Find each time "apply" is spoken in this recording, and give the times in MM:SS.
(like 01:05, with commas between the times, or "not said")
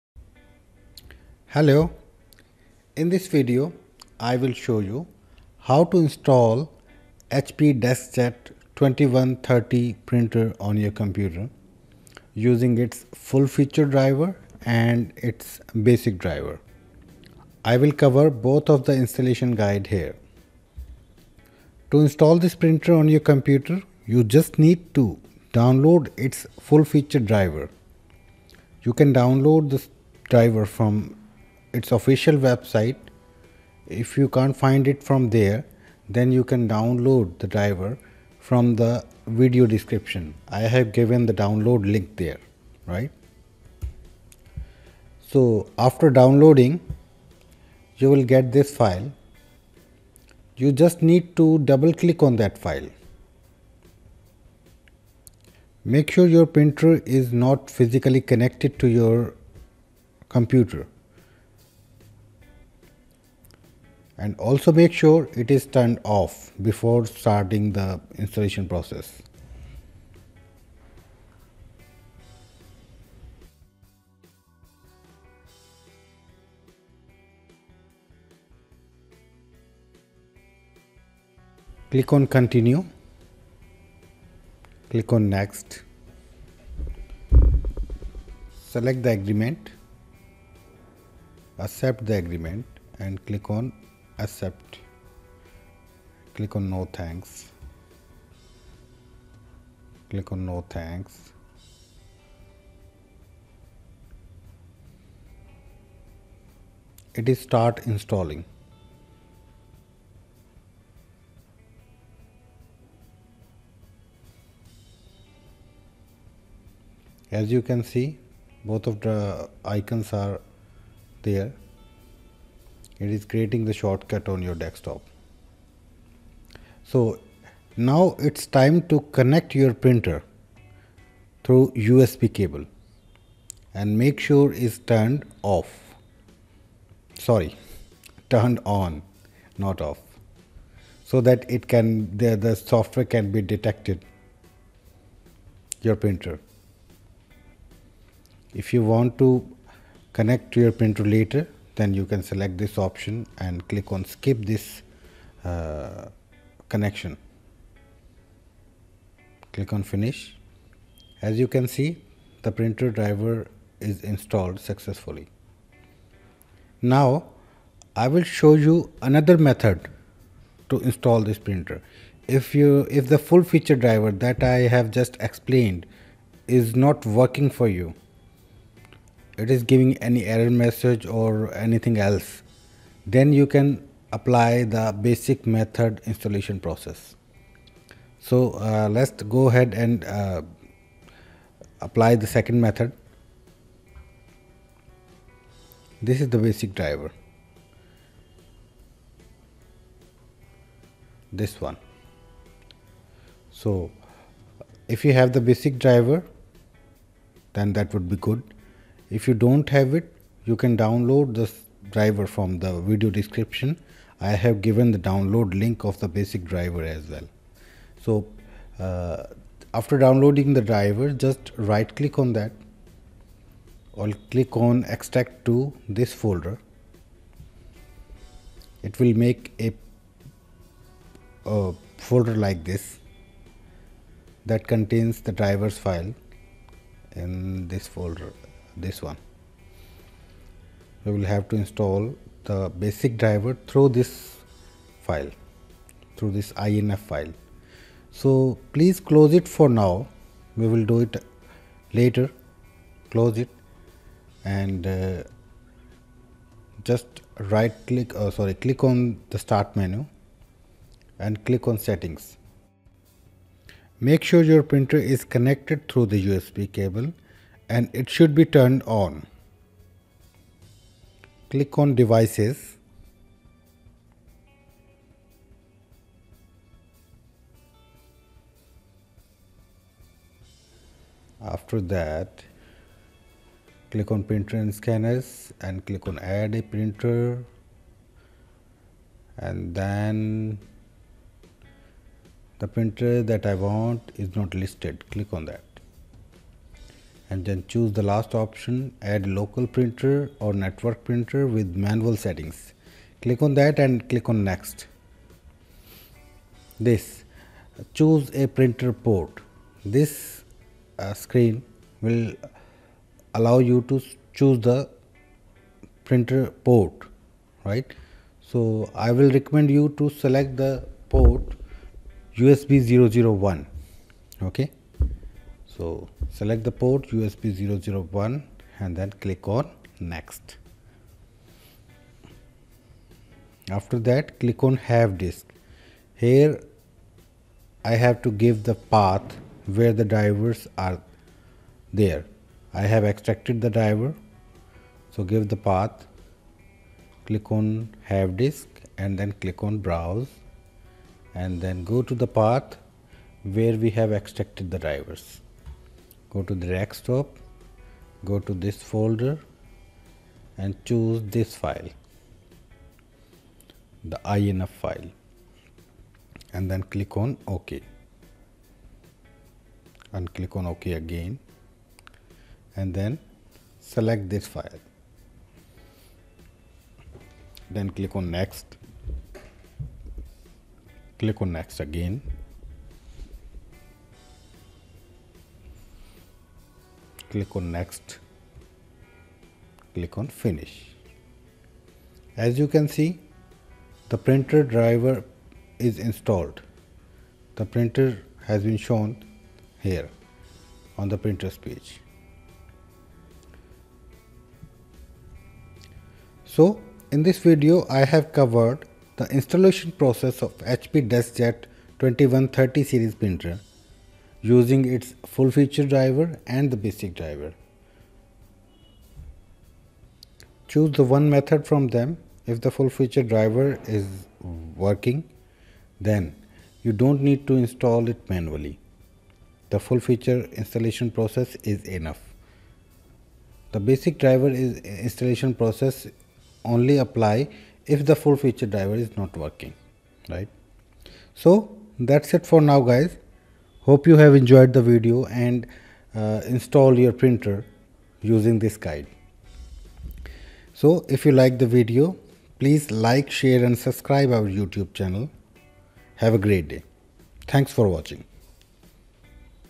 03:04, 03:11, 07:16.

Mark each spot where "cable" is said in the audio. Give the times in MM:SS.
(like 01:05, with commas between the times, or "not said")
02:12, 04:26.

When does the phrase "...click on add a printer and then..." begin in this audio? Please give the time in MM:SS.
04:45.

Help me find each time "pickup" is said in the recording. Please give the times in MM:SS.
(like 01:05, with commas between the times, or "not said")
not said.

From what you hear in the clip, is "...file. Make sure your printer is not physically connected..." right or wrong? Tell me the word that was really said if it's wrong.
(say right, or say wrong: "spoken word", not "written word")
right.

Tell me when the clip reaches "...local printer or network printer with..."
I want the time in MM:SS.
04:59.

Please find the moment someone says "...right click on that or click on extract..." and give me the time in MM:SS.
03:41.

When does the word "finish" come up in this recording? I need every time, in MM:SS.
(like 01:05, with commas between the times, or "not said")
02:39, 06:30.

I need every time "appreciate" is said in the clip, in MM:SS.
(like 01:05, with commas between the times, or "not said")
not said.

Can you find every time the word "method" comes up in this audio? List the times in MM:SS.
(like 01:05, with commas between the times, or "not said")
02:49, 03:05, 03:12, 07:01.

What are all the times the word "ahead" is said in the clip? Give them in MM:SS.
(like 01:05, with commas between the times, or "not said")
03:09.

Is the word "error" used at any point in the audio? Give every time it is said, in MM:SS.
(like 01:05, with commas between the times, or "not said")
03:00.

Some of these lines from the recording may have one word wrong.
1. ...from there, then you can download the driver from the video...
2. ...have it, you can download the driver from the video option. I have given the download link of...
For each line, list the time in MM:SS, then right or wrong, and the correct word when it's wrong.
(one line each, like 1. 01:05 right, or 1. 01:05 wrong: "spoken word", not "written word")
1. 00:35 right
2. 03:29 wrong: "description", not "option".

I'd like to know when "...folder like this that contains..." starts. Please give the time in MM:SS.
03:51.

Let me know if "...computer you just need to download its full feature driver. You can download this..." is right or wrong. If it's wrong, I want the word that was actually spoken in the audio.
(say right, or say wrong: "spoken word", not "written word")
right.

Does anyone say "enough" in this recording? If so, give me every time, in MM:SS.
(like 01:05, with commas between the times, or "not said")
07:11.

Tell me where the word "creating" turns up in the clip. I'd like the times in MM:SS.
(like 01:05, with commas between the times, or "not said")
02:03.